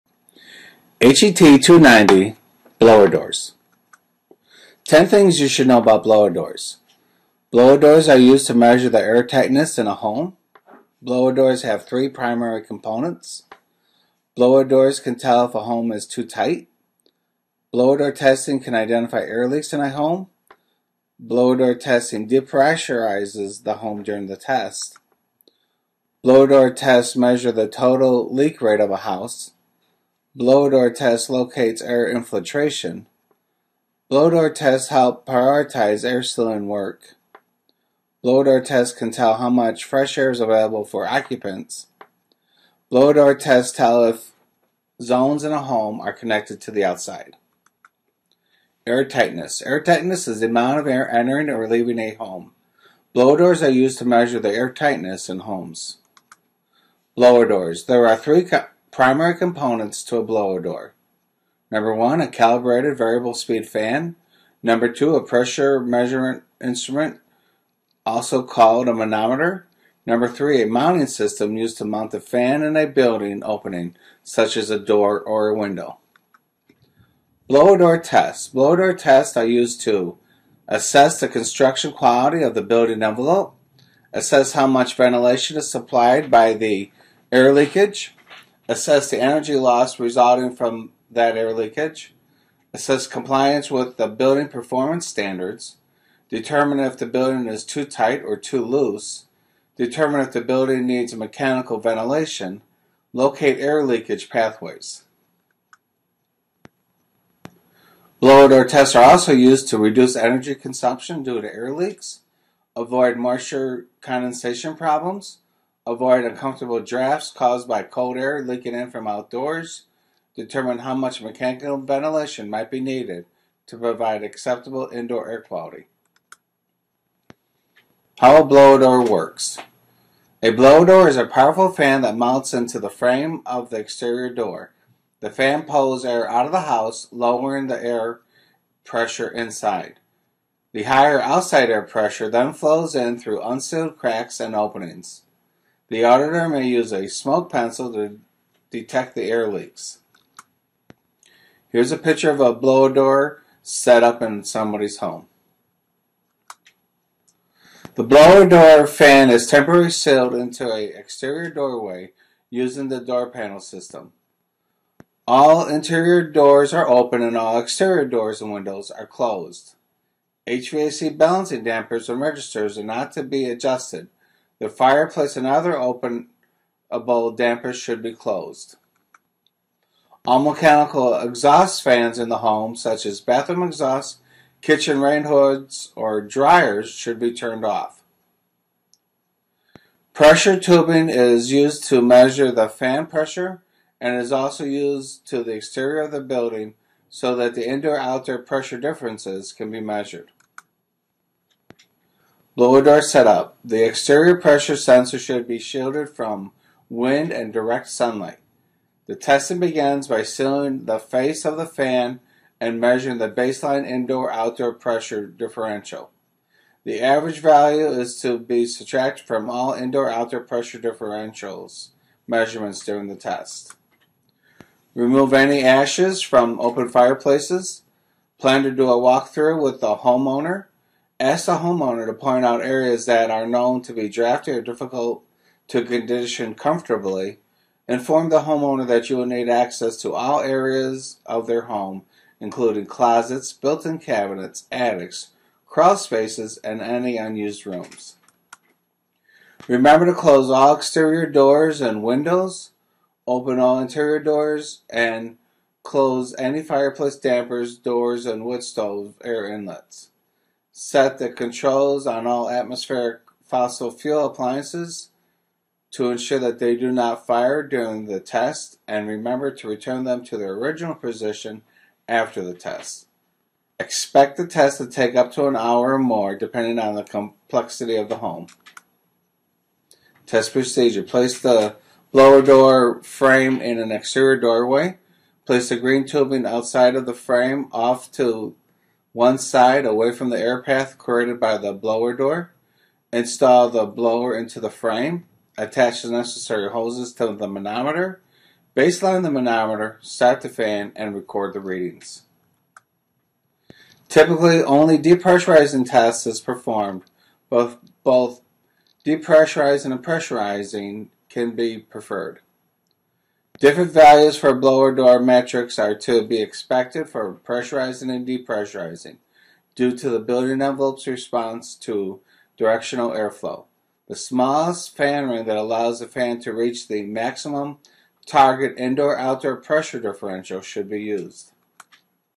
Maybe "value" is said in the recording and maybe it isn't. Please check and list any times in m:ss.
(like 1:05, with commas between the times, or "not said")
3:37, 5:13.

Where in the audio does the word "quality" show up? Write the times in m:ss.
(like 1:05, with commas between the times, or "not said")
1:21, 2:05.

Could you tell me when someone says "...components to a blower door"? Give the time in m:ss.
0:59.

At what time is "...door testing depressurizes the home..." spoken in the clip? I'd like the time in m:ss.
0:21.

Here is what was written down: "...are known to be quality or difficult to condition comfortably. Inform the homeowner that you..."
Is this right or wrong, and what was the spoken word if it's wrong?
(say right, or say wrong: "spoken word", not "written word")
wrong: "drafty", not "quality".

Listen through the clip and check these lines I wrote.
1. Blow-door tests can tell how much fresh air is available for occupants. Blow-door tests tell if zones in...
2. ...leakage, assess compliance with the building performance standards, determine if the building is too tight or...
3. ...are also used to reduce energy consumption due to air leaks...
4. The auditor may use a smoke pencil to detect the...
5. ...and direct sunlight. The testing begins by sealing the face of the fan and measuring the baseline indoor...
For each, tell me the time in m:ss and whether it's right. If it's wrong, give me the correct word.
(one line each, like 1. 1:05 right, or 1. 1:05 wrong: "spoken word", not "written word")
1. 0:38 right
2. 1:31 right
3. 1:48 right
4. 2:25 right
5. 3:27 right.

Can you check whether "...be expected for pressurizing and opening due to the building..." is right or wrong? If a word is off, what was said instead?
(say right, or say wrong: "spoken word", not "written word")
wrong: "depressurizing", not "opening".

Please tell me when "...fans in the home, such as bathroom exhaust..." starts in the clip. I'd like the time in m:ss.
3:01.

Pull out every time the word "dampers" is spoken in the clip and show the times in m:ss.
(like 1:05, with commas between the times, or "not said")
2:51, 2:57, 4:17.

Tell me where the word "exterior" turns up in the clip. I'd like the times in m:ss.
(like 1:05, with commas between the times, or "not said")
2:13, 2:40, 2:47, 3:15, 3:23, 4:10, 4:43.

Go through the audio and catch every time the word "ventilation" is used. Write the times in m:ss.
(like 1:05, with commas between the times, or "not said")
1:24, 1:41, 2:01.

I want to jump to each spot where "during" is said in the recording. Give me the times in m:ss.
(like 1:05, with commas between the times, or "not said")
0:24, 3:42, 4:27.